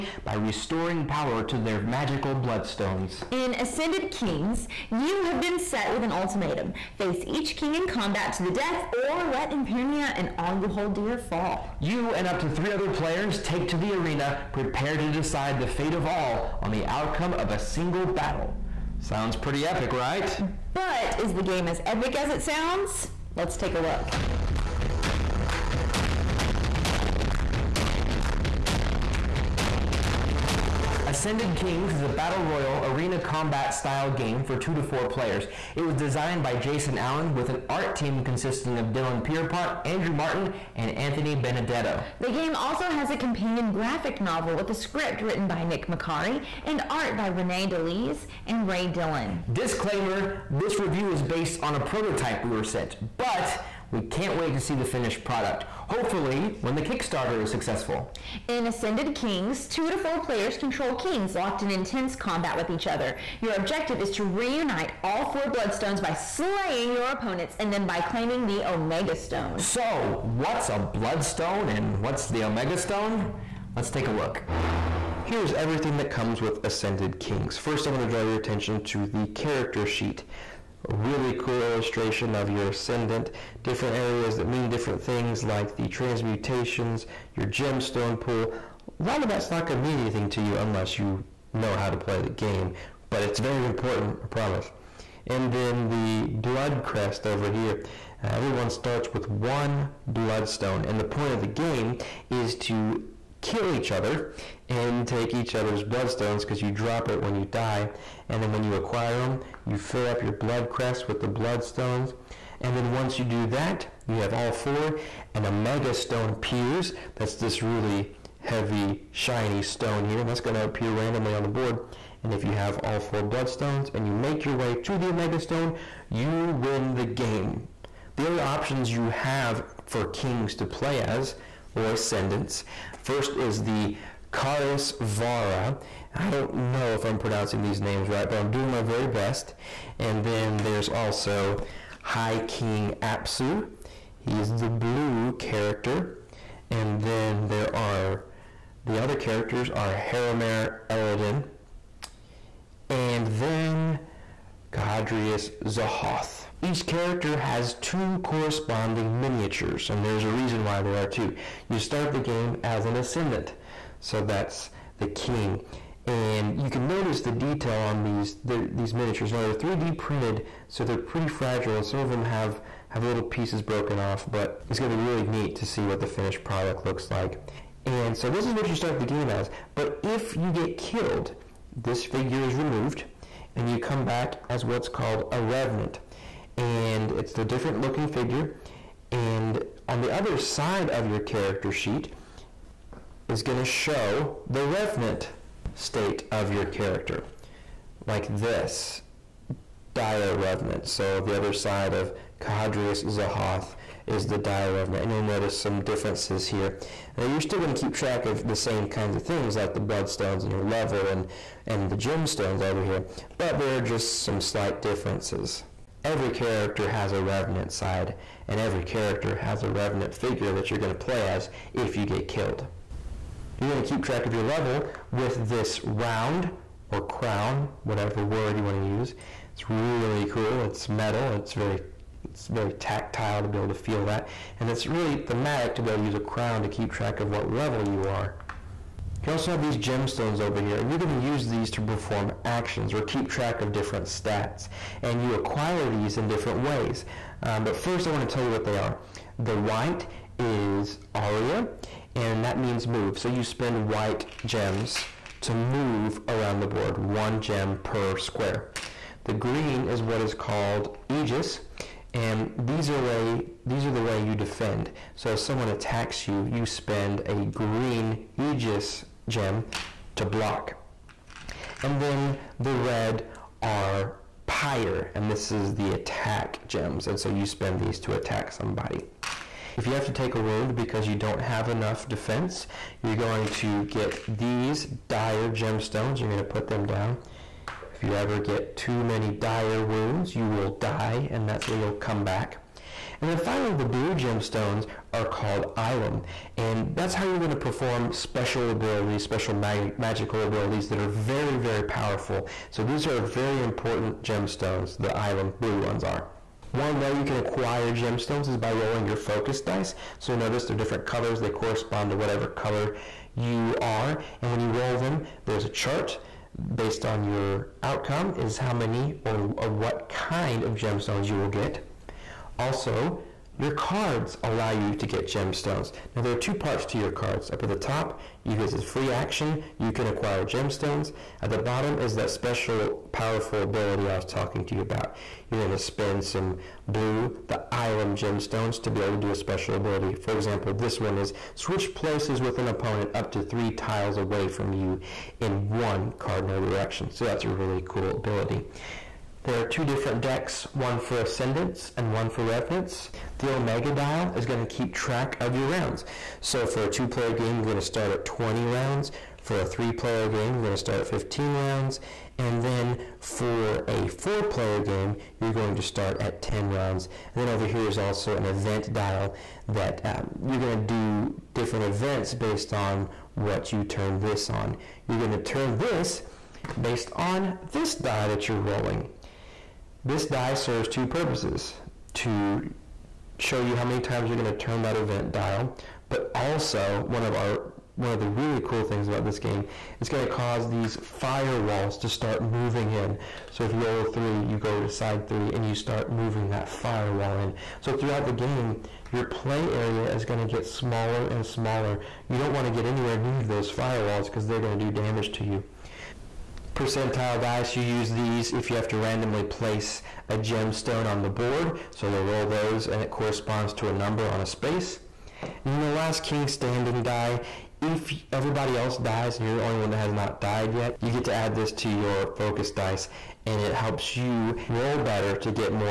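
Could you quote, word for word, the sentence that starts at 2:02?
And if you have all four bloodstones and you make your way to the Omega Stone, you win the game.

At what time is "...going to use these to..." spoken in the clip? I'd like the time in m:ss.
4:00.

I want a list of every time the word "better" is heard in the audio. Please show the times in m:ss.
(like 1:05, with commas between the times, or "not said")
7:05.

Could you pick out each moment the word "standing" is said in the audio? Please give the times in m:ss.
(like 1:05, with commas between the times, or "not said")
6:56.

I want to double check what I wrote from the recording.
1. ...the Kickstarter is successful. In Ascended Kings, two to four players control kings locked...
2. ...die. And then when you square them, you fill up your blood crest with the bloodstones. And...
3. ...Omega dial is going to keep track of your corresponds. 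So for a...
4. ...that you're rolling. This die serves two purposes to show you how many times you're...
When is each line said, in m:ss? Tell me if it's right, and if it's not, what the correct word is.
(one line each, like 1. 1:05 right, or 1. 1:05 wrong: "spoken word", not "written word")
1. 0:56 right
2. 1:47 wrong: "acquire", not "square"
3. 5:53 wrong: "rounds", not "corresponds"
4. 6:18 right.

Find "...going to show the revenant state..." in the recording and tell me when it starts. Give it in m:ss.
3:13.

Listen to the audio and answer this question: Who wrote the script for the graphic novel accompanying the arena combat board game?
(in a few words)
Nick Macari.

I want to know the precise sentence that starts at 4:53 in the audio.
And then finally, the blue gemstones are called Ilum.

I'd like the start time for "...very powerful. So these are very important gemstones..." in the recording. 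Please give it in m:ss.
5:01.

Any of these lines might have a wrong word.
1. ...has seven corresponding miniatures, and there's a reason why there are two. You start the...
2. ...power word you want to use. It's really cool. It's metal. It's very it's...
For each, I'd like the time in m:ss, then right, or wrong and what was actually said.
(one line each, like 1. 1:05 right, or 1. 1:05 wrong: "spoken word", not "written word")
1. 2:37 wrong: "two", not "seven"
2. 3:47 wrong: "whatever", not "power".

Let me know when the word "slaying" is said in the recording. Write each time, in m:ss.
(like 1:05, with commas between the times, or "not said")
1:06.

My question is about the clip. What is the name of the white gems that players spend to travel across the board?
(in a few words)
aria.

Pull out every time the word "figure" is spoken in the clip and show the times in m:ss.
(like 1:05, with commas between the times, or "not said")
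3:02, 3:08, 3:40.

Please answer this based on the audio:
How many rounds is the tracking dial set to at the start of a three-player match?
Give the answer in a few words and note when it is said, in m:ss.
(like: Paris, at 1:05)
15, at 6:01.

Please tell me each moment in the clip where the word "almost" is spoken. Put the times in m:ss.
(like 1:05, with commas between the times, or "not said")
not said.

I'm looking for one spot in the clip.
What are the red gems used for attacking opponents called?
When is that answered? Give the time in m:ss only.
4:34.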